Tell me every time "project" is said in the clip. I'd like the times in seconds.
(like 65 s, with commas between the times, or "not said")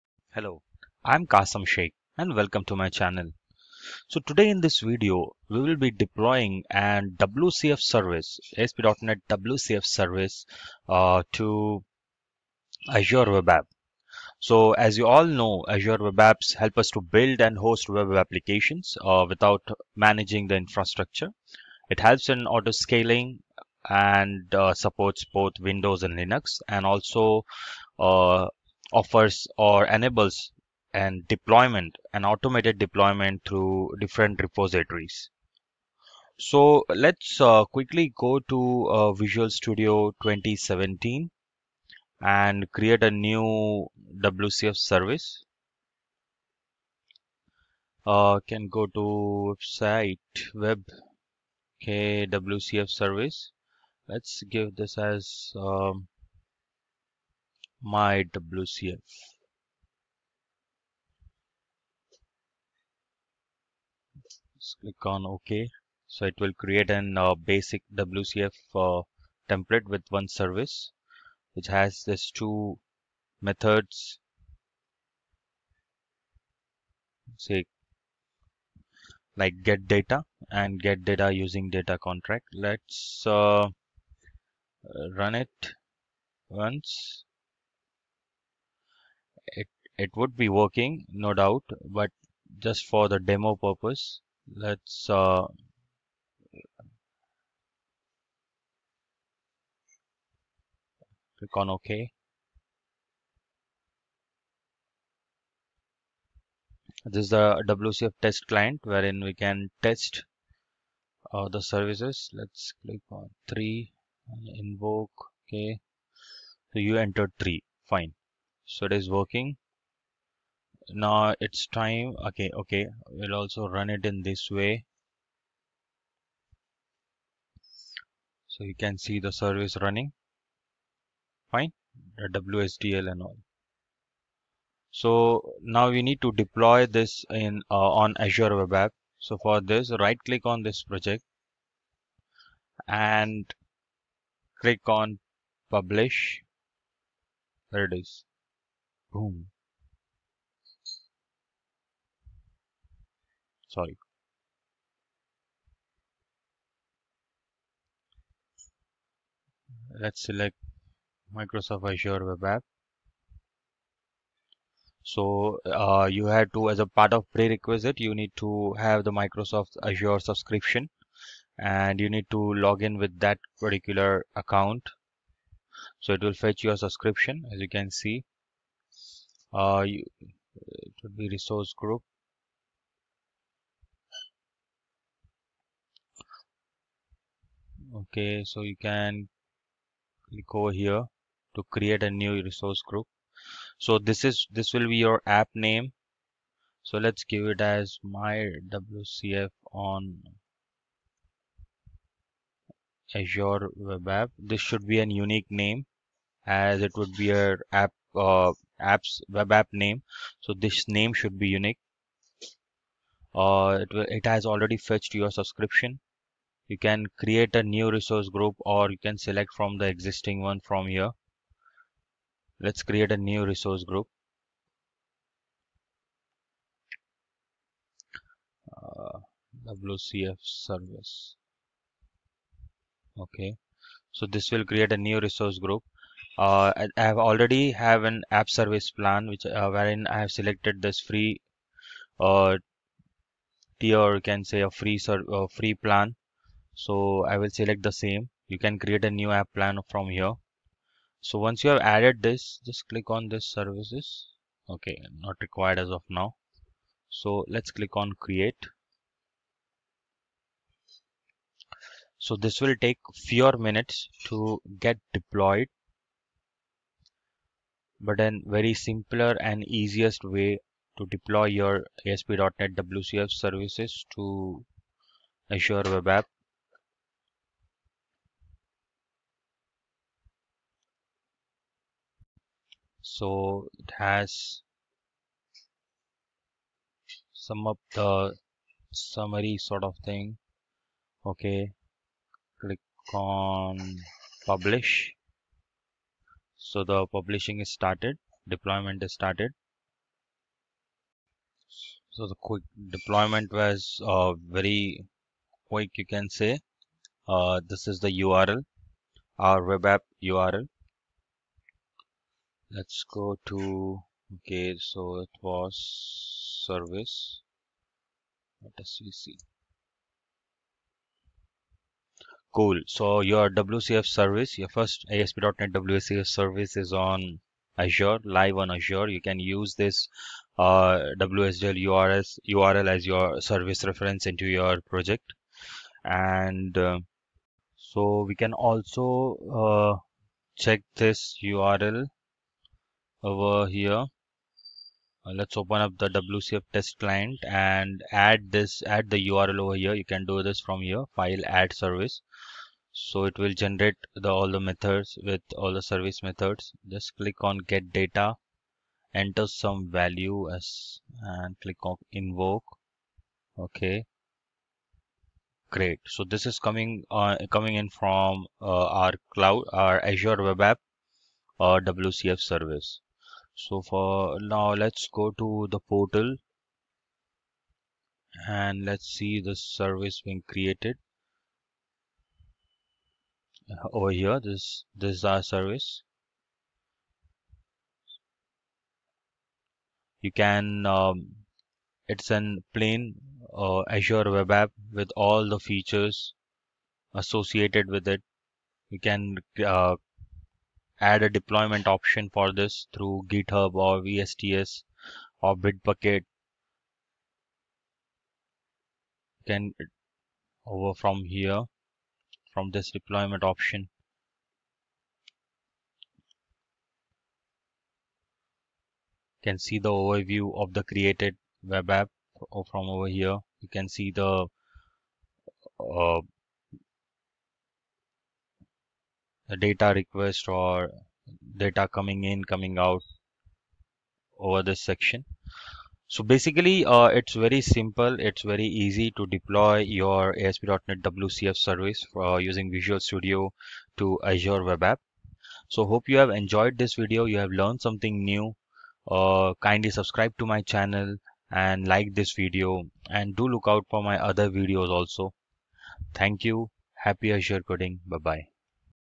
140 s, 334 s.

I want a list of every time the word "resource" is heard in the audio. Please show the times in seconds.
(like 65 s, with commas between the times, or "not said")
181 s, 192 s, 217 s, 223 s, 235 s.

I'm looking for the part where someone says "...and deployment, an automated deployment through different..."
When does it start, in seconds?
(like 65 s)
30 s.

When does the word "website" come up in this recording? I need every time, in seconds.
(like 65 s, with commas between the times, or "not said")
49 s.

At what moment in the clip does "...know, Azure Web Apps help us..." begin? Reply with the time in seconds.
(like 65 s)
15 s.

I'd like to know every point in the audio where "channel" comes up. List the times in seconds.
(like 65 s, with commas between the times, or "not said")
2 s, 450 s.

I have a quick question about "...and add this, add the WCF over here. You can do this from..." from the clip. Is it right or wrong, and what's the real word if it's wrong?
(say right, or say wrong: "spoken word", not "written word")
wrong: "URL", not "WCF".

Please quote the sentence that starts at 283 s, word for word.
So it has some of the summary sort of thing.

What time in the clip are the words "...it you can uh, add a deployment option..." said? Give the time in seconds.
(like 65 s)
398 s.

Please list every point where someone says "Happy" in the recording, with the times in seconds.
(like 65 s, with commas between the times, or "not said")
457 s.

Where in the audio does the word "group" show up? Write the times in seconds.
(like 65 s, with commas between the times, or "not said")
181 s, 192 s, 218 s, 223 s, 235 s.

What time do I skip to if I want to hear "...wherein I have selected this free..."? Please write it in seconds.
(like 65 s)
239 s.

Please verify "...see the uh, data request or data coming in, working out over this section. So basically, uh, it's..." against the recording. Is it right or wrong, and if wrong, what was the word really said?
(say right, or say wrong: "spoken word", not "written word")
wrong: "coming", not "working".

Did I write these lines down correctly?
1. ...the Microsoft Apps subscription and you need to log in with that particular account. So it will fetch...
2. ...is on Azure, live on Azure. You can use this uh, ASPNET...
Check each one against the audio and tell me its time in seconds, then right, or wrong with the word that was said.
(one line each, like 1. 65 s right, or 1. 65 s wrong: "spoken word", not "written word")
1. 169 s wrong: "Azure", not "Apps"
2. 326 s wrong: "WSDL", not "ASPNET".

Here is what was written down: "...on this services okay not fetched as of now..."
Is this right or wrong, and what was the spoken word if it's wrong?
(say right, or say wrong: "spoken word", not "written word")
wrong: "required", not "fetched".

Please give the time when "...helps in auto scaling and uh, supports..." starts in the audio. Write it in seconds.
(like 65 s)
21 s.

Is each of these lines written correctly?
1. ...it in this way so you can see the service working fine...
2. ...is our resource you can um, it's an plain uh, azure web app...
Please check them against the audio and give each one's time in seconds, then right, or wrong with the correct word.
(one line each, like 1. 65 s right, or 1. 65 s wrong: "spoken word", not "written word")
1. 123 s wrong: "running", not "working"
2. 385 s wrong: "service", not "resource".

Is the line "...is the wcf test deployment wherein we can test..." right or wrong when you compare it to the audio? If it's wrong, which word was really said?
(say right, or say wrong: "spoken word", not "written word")
wrong: "client", not "deployment".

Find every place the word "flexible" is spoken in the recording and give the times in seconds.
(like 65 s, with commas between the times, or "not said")
not said.